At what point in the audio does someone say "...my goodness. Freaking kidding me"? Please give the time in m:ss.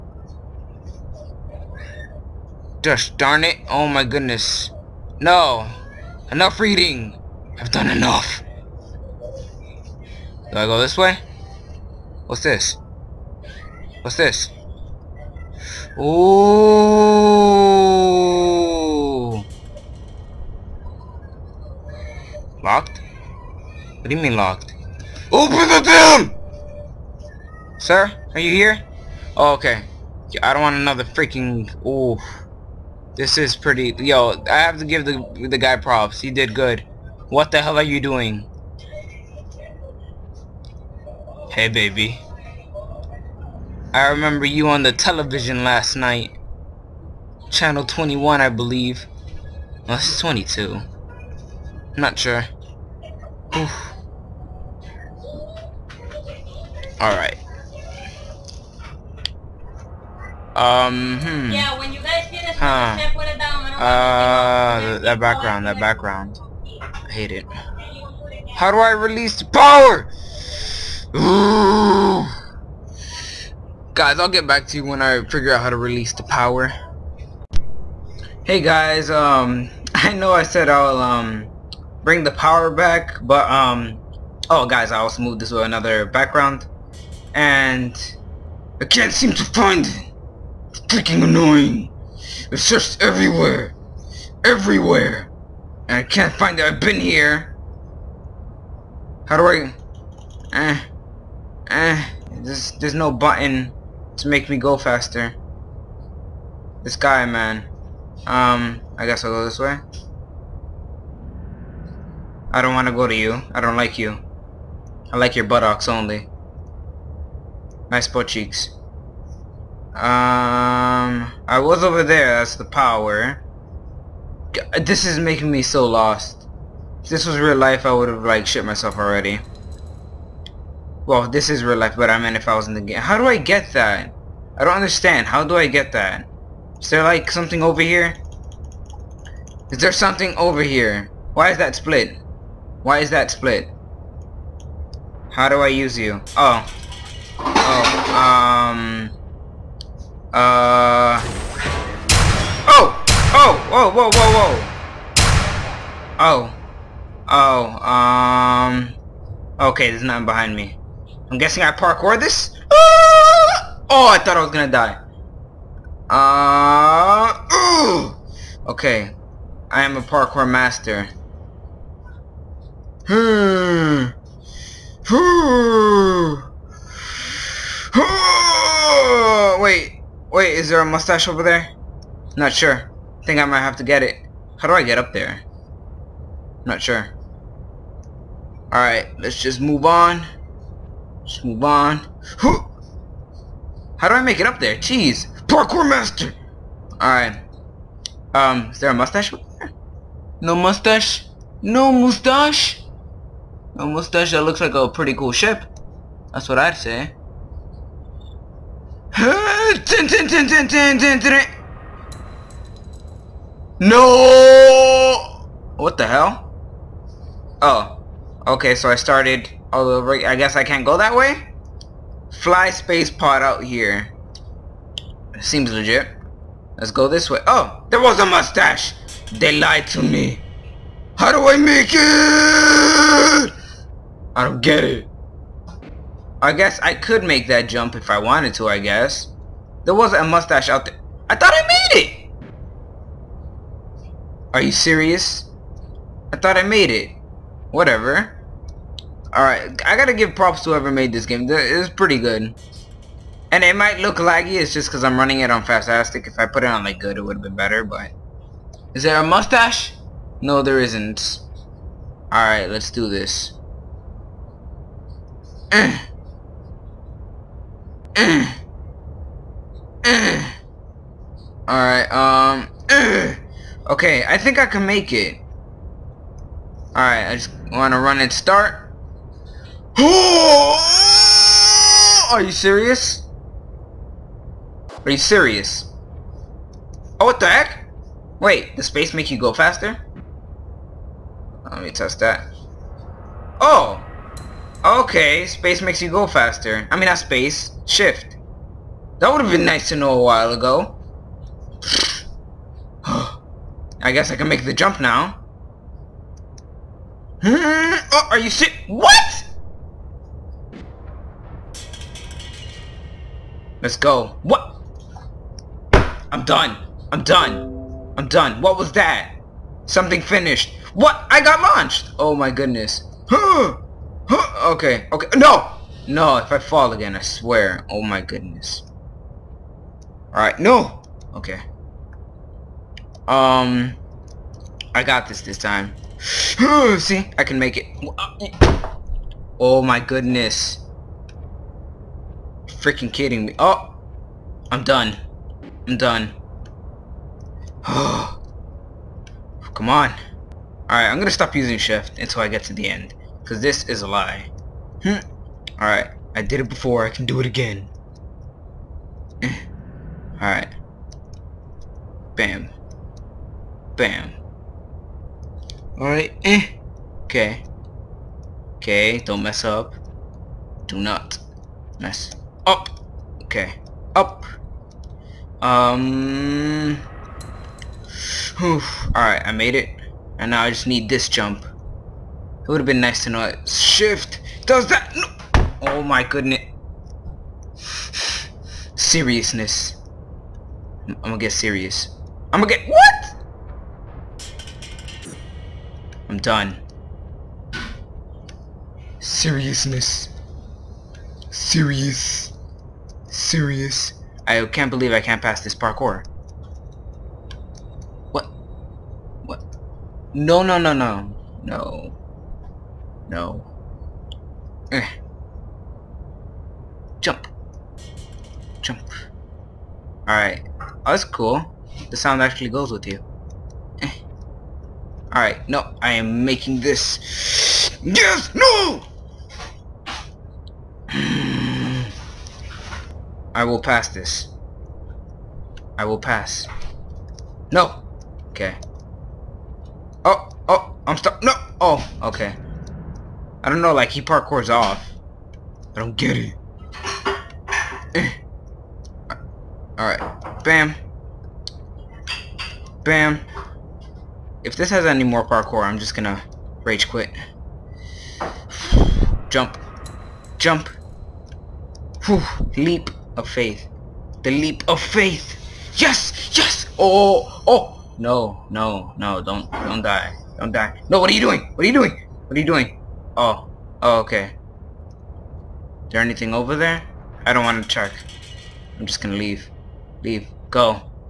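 5:39.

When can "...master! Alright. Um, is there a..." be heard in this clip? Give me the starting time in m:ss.
3:15.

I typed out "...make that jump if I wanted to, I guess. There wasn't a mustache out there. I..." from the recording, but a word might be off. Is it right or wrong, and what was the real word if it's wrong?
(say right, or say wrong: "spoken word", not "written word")
right.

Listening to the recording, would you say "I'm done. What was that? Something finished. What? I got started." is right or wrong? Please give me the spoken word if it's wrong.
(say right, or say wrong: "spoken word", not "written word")
wrong: "launched", not "started".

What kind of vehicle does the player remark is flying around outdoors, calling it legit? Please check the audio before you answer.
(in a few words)
space pod.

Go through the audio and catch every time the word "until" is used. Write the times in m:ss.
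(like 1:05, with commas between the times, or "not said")
5:52.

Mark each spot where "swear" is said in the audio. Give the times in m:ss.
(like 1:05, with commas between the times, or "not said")
5:27.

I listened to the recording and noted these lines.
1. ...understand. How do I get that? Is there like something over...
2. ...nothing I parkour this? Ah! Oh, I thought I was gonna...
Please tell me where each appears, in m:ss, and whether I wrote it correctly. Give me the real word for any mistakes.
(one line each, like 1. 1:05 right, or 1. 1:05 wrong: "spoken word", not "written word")
1. 2:14 right
2. 2:41 wrong: "guessing", not "nothing".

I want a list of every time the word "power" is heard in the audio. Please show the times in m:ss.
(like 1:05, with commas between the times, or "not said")
1:09, 1:16, 1:22, 2:02.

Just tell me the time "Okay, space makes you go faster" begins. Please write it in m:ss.
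4:54.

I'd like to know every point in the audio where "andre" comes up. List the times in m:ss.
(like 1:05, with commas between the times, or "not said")
not said.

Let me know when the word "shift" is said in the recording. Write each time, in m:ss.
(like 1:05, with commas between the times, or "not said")
4:57, 5:51, 6:23.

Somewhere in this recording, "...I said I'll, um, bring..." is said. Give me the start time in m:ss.
1:20.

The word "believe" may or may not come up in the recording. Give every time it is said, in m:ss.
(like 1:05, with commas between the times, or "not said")
0:48, 6:44.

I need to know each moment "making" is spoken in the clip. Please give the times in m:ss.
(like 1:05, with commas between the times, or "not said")
2:05, 7:06.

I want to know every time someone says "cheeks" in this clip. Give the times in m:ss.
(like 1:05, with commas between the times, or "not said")
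1:58.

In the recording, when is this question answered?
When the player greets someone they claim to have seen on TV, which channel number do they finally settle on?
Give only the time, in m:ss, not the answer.
0:49.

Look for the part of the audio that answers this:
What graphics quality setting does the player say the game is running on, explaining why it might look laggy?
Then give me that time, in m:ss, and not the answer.
4:15.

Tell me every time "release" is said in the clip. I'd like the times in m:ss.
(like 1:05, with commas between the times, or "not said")
1:08, 1:15.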